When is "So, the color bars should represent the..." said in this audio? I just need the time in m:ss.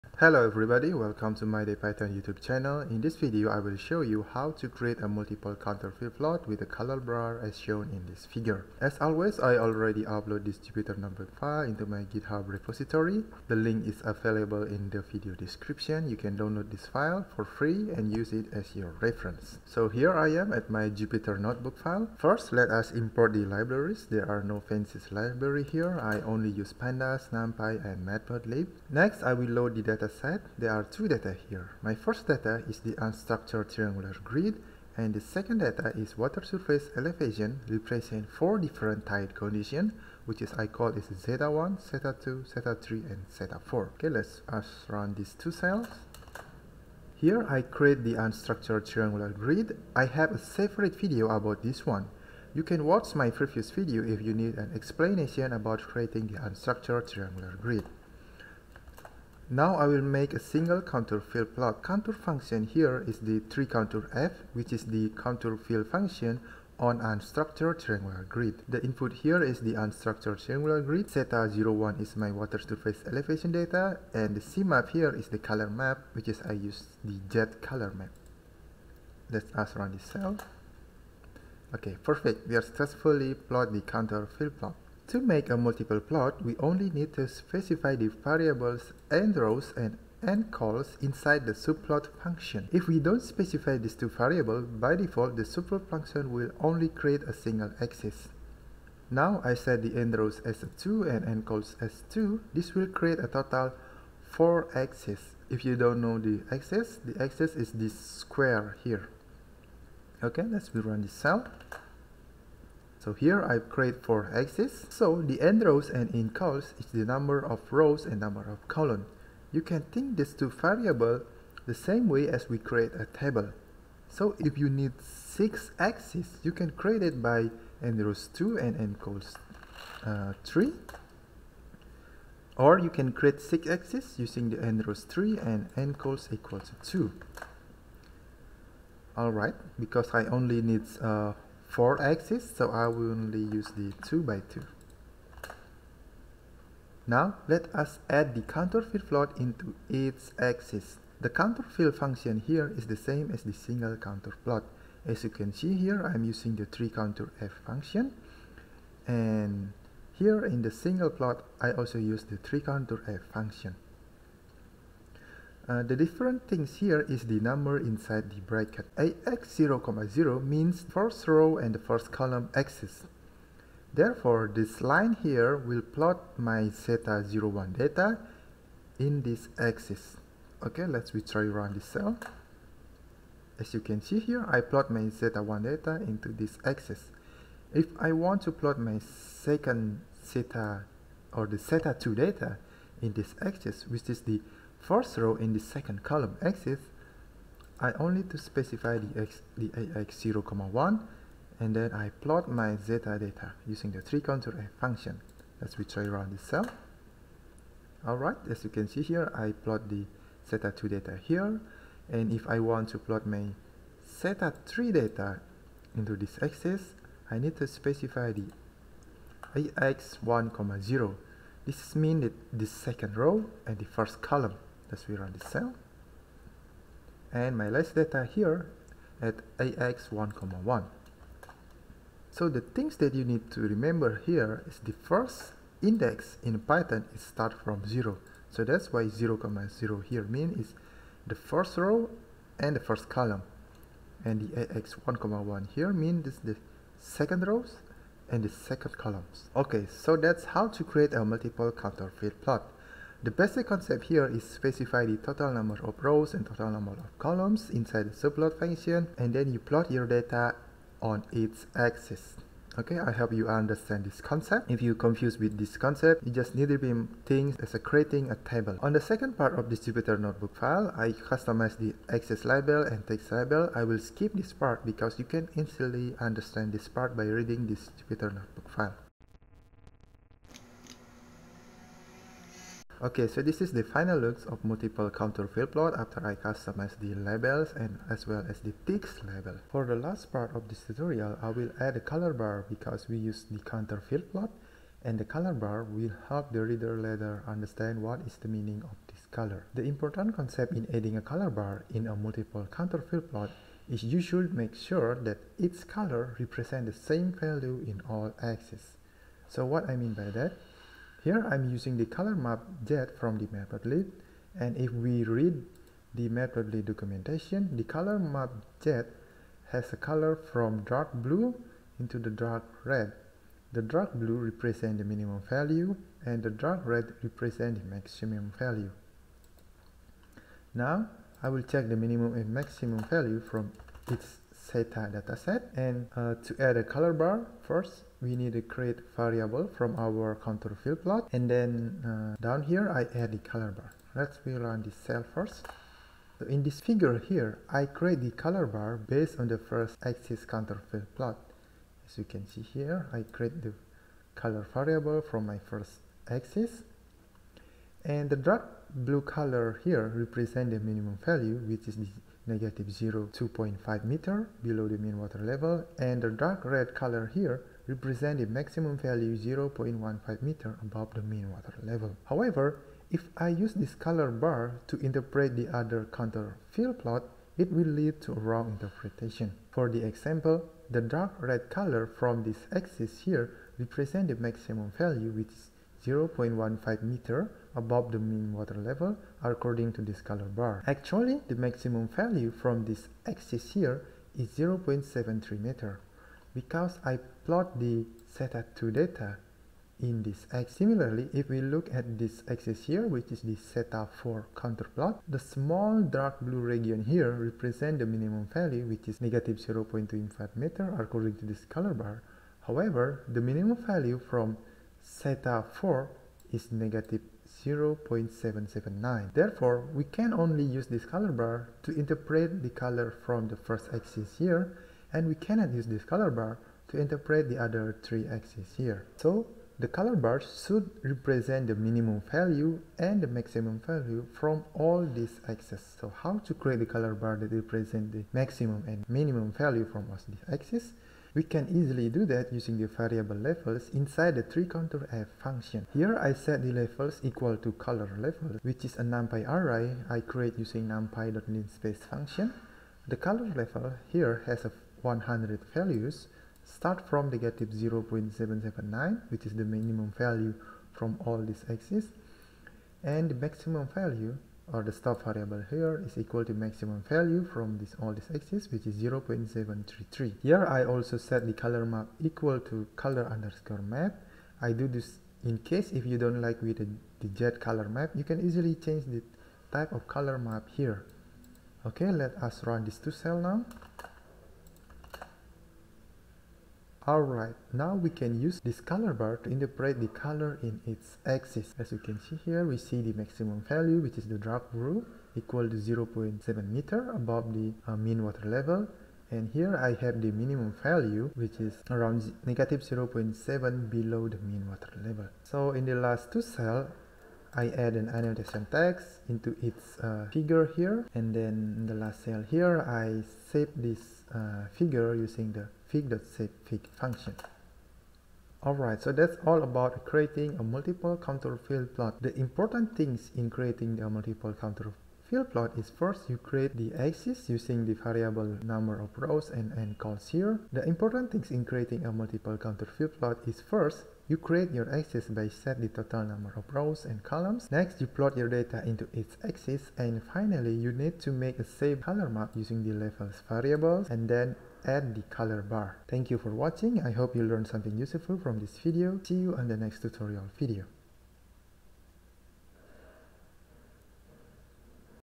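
7:09.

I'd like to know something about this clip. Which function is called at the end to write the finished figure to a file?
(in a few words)
fig.savefig.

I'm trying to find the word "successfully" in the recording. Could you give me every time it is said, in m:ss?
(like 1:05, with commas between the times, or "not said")
1:22.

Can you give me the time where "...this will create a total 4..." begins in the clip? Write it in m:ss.
1:42.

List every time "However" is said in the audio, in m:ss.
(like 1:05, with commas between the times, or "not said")
6:12, 6:52.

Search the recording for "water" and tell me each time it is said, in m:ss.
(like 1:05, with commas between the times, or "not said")
0:36, 1:12, 6:05, 6:11, 6:28, 8:18, 8:24.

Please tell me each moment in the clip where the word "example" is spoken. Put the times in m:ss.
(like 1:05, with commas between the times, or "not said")
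6:20.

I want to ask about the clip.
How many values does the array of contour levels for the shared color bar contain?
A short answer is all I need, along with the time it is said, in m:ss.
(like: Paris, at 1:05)
100, at 7:34.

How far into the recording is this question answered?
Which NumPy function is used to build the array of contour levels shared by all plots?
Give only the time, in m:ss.
7:30.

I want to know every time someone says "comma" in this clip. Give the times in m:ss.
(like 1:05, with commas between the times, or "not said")
3:20, 3:50, 3:59, 4:05.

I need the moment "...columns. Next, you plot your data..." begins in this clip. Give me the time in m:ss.
8:57.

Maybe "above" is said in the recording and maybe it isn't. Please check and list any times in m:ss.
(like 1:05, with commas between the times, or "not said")
6:10, 6:27, 8:17.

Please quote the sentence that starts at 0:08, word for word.
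As always, I already upload this Jupyter notebook file into my GitHub repository.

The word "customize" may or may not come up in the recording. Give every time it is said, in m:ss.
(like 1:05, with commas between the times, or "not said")
4:31, 4:46.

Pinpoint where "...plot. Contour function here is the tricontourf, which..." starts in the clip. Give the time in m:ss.
1:01.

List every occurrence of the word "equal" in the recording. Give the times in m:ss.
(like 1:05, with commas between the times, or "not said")
2:16, 7:27, 7:46, 7:52, 8:15.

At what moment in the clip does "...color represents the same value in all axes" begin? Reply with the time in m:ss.
5:05.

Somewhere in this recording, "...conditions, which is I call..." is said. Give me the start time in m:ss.
0:39.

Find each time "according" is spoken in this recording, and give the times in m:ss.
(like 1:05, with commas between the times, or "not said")
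6:29, 6:50.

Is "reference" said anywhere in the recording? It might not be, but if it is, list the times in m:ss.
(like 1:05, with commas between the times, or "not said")
0:19.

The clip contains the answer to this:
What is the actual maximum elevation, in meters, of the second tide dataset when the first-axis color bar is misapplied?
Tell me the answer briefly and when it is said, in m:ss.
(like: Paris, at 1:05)
0.73, at 6:34.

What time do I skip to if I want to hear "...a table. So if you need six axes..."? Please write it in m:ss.
2:02.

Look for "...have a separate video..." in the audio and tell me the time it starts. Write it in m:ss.
0:50.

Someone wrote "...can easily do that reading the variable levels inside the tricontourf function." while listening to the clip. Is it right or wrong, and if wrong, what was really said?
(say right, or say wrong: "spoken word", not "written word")
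wrong: "using", not "reading".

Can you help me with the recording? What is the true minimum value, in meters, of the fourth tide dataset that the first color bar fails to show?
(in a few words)
-0.779.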